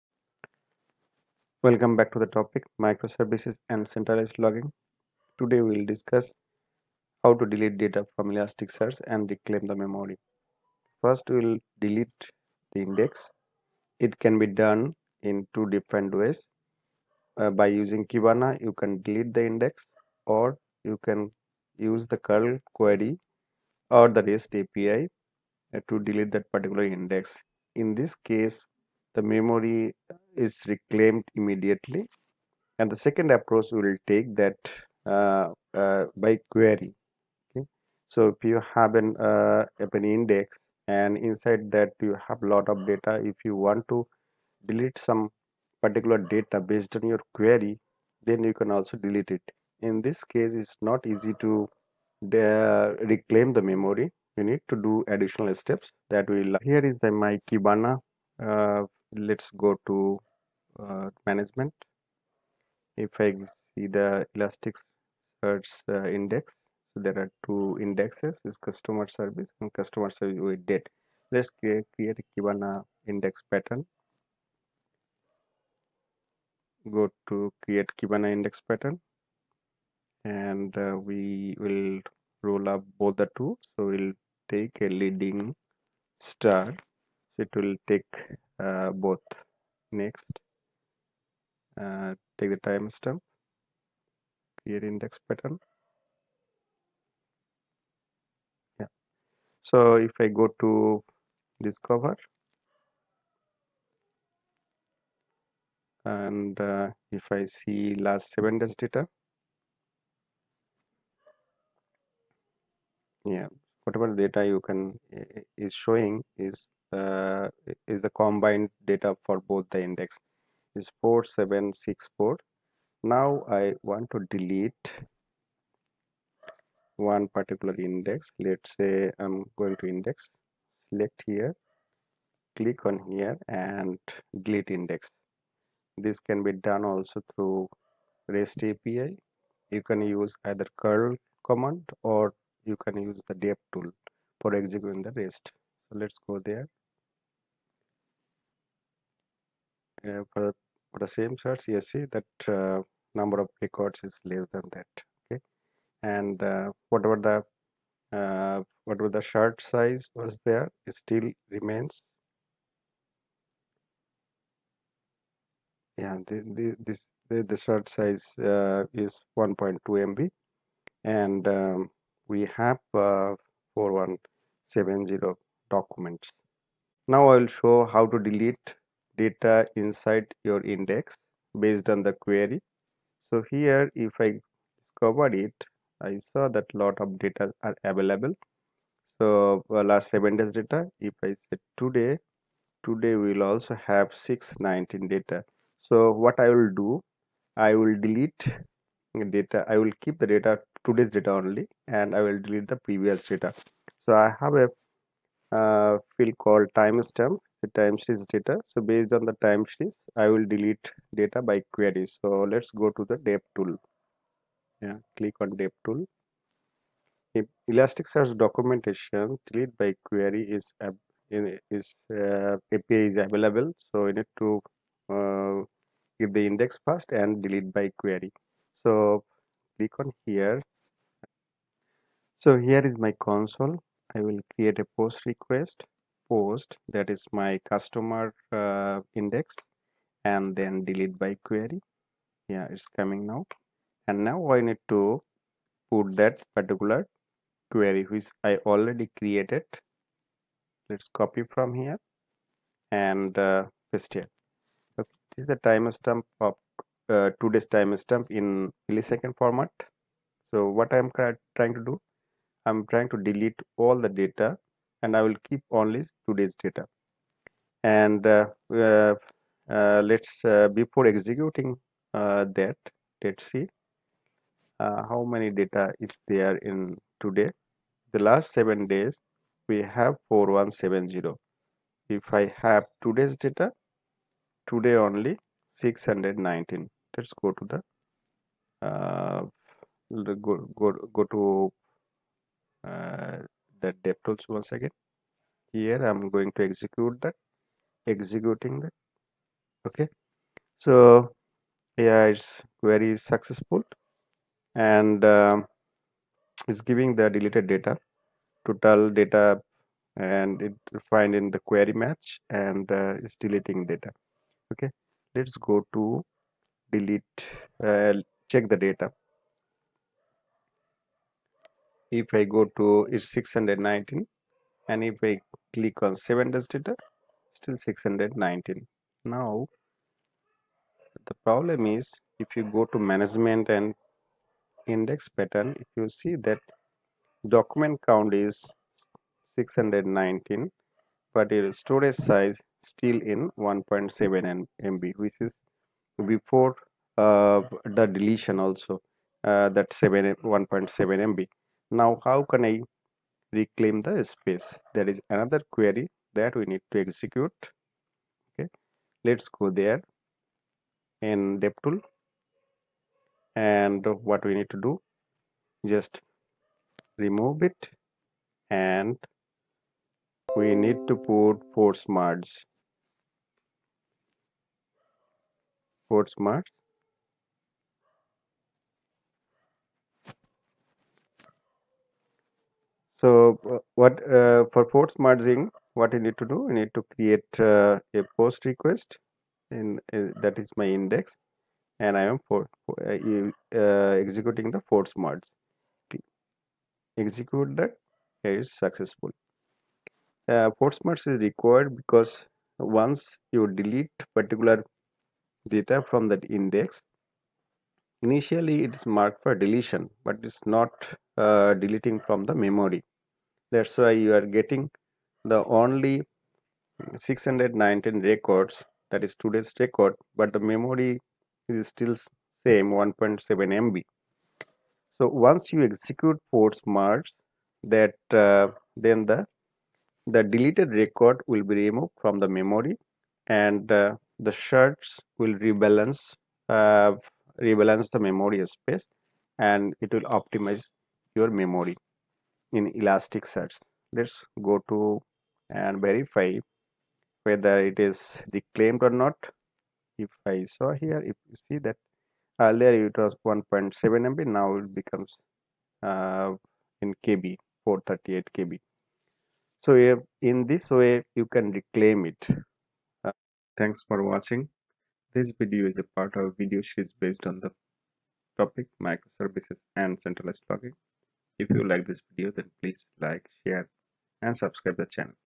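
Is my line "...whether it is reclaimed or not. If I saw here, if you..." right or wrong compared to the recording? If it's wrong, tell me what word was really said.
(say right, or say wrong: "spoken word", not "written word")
right.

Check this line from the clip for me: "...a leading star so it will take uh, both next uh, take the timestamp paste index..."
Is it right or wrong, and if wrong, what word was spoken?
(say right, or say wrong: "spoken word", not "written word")
wrong: "create", not "paste".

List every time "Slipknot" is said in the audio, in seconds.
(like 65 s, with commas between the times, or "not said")
not said.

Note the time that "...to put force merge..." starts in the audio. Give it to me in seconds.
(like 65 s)
371 s.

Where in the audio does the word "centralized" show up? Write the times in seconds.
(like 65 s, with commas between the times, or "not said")
3 s, 470 s.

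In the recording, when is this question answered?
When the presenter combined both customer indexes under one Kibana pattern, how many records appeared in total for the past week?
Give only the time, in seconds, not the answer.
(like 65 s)
121 s.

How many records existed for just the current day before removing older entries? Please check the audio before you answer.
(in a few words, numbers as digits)
619.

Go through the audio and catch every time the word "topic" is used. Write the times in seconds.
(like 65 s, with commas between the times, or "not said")
2 s, 468 s.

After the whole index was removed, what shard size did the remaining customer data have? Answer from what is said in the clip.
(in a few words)
1.2 MB.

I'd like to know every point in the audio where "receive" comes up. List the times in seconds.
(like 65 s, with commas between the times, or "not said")
not said.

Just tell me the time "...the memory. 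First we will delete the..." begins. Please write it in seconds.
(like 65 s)
9 s.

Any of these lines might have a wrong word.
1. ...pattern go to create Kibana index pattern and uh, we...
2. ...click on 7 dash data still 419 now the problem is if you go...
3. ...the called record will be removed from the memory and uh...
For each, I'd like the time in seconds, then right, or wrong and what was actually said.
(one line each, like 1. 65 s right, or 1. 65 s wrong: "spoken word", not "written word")
1. 73 s right
2. 325 s wrong: "619", not "419"
3. 430 s wrong: "deleted", not "called".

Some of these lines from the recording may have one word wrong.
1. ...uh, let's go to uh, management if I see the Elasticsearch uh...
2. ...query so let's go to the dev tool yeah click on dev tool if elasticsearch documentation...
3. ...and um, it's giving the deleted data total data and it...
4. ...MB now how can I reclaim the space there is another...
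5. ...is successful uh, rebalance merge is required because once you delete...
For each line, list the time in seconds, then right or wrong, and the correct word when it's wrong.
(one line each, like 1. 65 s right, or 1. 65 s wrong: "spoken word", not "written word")
1. 58 s right
2. 211 s right
3. 304 s right
4. 351 s right
5. 398 s wrong: "force", not "rebalance".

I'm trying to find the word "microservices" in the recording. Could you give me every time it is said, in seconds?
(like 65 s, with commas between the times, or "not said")
2 s, 469 s.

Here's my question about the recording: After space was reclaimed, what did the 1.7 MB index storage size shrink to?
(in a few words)
438 KB.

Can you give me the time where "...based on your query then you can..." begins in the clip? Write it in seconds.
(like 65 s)
46 s.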